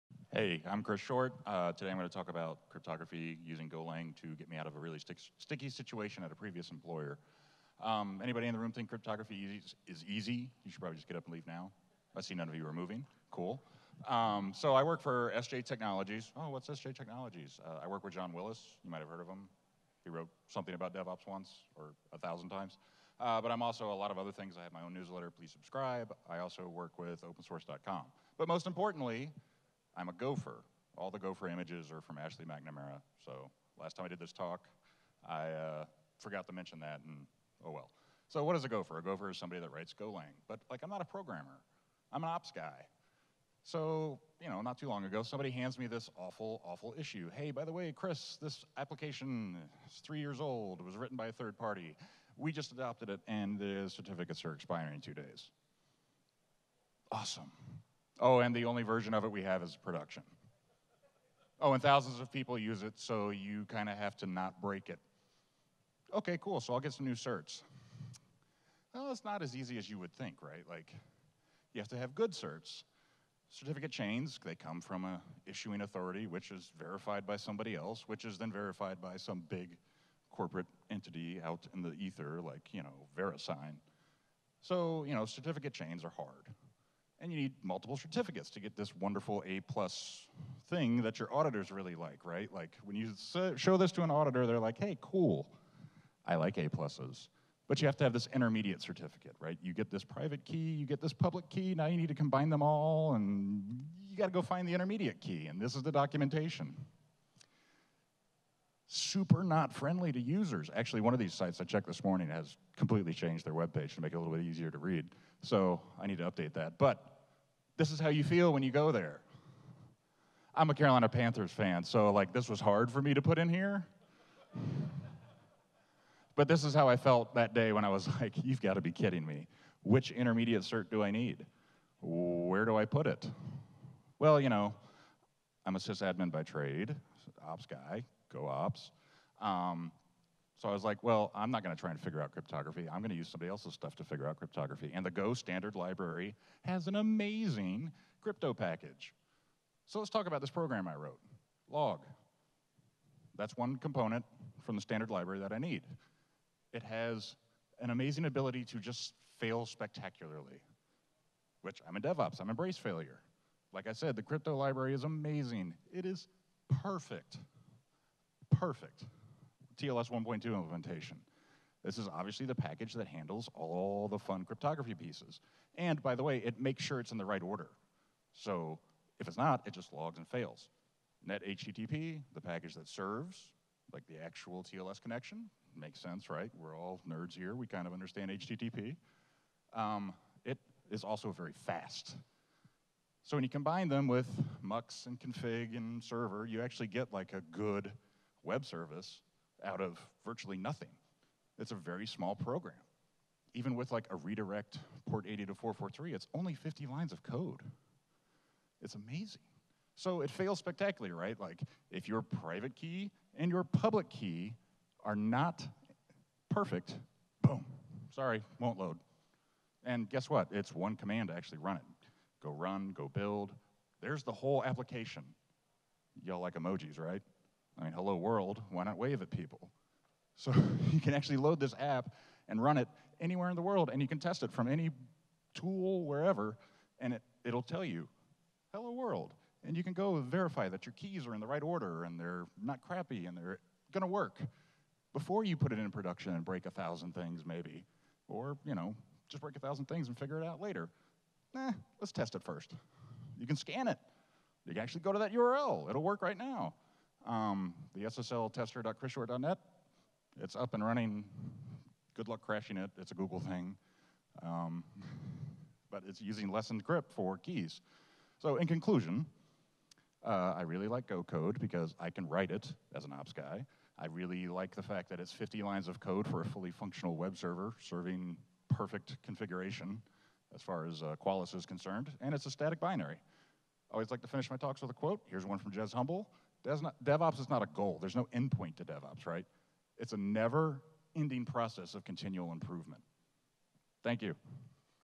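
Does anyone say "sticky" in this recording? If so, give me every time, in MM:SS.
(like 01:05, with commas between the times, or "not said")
00:05.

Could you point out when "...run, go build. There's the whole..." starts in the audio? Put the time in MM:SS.
03:42.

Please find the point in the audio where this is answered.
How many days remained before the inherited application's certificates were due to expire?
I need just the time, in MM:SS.
00:55.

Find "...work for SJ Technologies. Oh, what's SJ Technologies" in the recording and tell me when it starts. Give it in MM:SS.
00:14.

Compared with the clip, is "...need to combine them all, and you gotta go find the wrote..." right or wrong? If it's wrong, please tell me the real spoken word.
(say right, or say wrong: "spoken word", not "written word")
wrong: "intermediate", not "wrote".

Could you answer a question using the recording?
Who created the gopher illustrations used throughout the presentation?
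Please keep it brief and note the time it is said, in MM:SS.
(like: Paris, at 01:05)
Ashley McNamara, at 00:32.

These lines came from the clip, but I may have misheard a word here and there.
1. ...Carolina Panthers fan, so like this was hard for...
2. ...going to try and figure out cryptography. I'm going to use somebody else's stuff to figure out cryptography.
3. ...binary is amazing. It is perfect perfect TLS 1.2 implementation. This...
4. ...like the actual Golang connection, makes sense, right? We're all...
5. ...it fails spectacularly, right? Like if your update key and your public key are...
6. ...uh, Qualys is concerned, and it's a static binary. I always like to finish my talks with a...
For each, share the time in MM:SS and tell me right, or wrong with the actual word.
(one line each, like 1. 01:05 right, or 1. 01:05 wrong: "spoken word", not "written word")
1. 02:00 right
2. 02:21 right
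3. 02:44 wrong: "library", not "binary"
4. 03:03 wrong: "TLS", not "Golang"
5. 03:30 wrong: "private", not "update"
6. 04:41 right.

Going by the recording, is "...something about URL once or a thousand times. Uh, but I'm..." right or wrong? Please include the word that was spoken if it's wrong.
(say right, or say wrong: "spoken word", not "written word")
wrong: "DevOps", not "URL".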